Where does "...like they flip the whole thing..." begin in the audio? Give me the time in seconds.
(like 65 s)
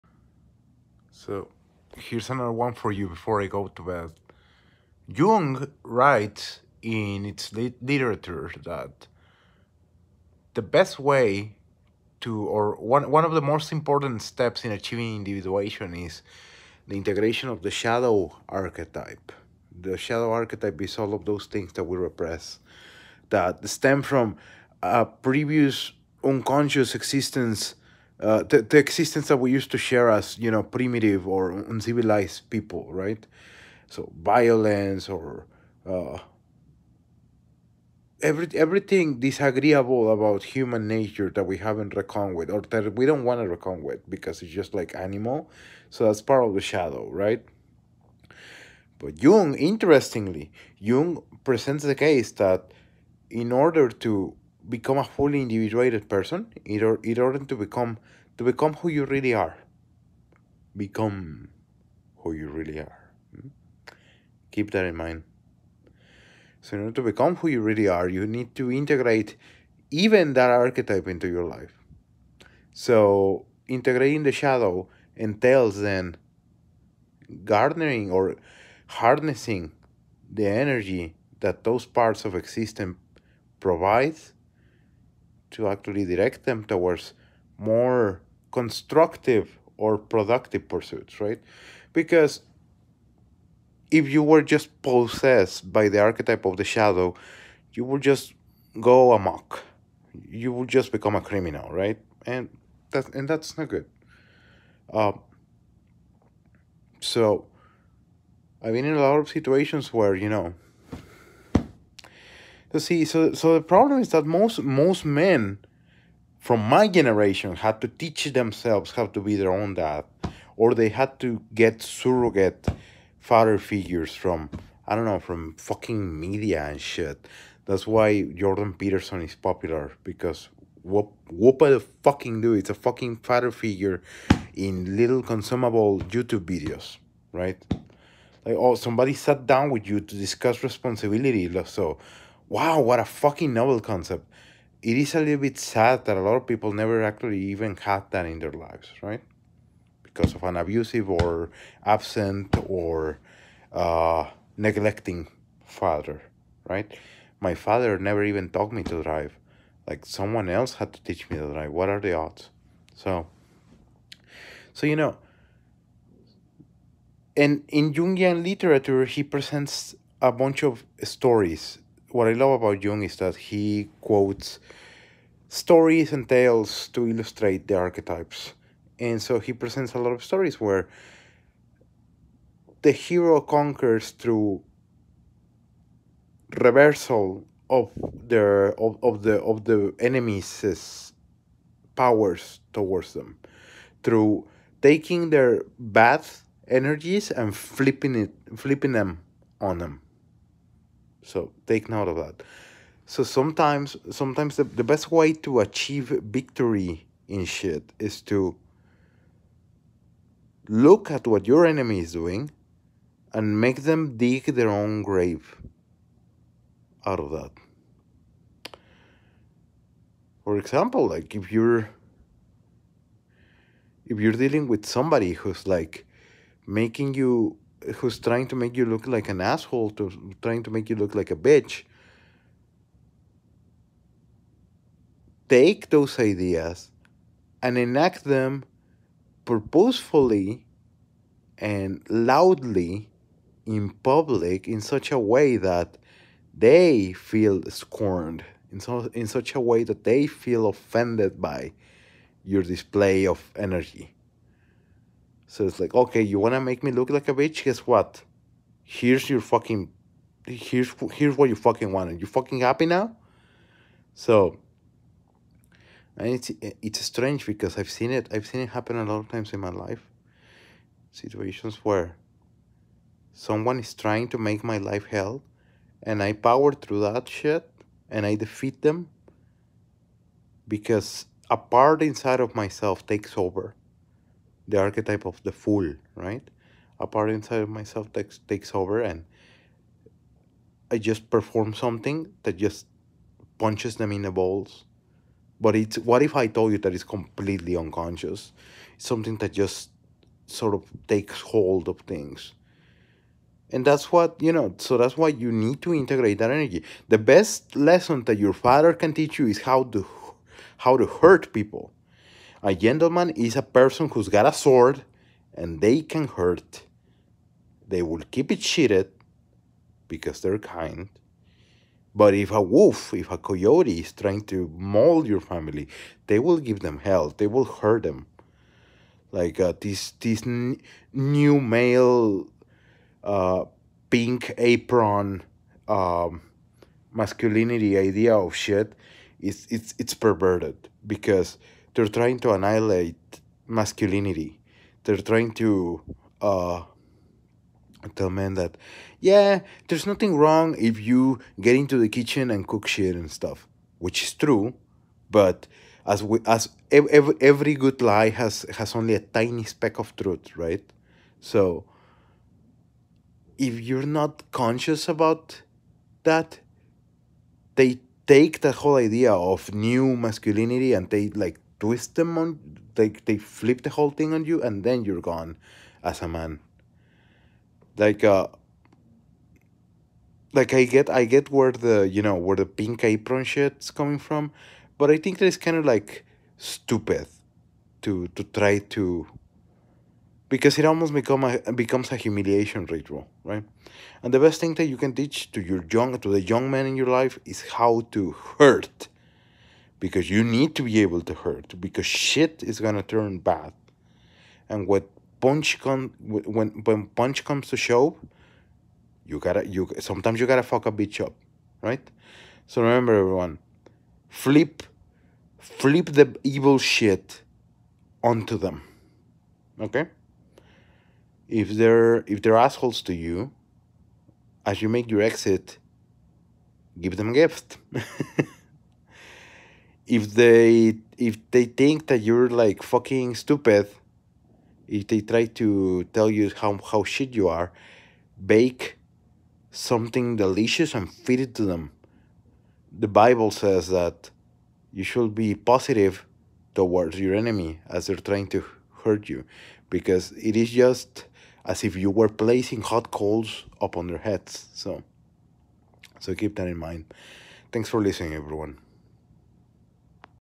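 372 s.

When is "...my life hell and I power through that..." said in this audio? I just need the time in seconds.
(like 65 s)
274 s.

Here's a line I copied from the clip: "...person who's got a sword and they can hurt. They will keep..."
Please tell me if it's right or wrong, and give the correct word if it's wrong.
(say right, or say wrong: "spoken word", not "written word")
right.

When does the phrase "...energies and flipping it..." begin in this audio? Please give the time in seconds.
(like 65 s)
196 s.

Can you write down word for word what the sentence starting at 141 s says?
So wow, what a fucking novel concept.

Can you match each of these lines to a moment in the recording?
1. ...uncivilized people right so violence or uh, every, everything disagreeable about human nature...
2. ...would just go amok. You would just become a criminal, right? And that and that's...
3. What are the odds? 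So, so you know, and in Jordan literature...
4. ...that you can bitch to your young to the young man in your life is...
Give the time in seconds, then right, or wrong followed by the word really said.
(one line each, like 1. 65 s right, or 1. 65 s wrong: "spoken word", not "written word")
1. 31 s right
2. 97 s right
3. 161 s wrong: "Jungian", not "Jordan"
4. 394 s wrong: "teach", not "bitch".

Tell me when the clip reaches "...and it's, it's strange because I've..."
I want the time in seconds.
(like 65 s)
266 s.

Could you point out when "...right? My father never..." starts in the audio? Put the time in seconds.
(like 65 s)
156 s.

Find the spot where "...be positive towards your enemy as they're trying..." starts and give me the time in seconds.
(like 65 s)
445 s.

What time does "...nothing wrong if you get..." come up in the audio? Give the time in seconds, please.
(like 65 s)
350 s.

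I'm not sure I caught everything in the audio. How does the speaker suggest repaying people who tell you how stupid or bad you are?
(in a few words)
bake something delicious.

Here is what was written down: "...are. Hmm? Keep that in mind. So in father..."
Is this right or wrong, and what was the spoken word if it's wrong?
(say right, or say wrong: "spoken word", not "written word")
wrong: "order", not "father".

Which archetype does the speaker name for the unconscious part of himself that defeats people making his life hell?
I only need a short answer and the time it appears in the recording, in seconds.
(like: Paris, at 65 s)
the fool, at 285 s.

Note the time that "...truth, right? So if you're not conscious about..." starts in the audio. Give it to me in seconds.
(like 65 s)
360 s.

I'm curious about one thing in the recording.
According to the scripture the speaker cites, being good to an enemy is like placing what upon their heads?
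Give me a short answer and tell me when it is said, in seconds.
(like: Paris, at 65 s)
hot coals, at 452 s.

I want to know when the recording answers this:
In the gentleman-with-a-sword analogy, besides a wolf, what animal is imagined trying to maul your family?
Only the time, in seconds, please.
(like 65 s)
323 s.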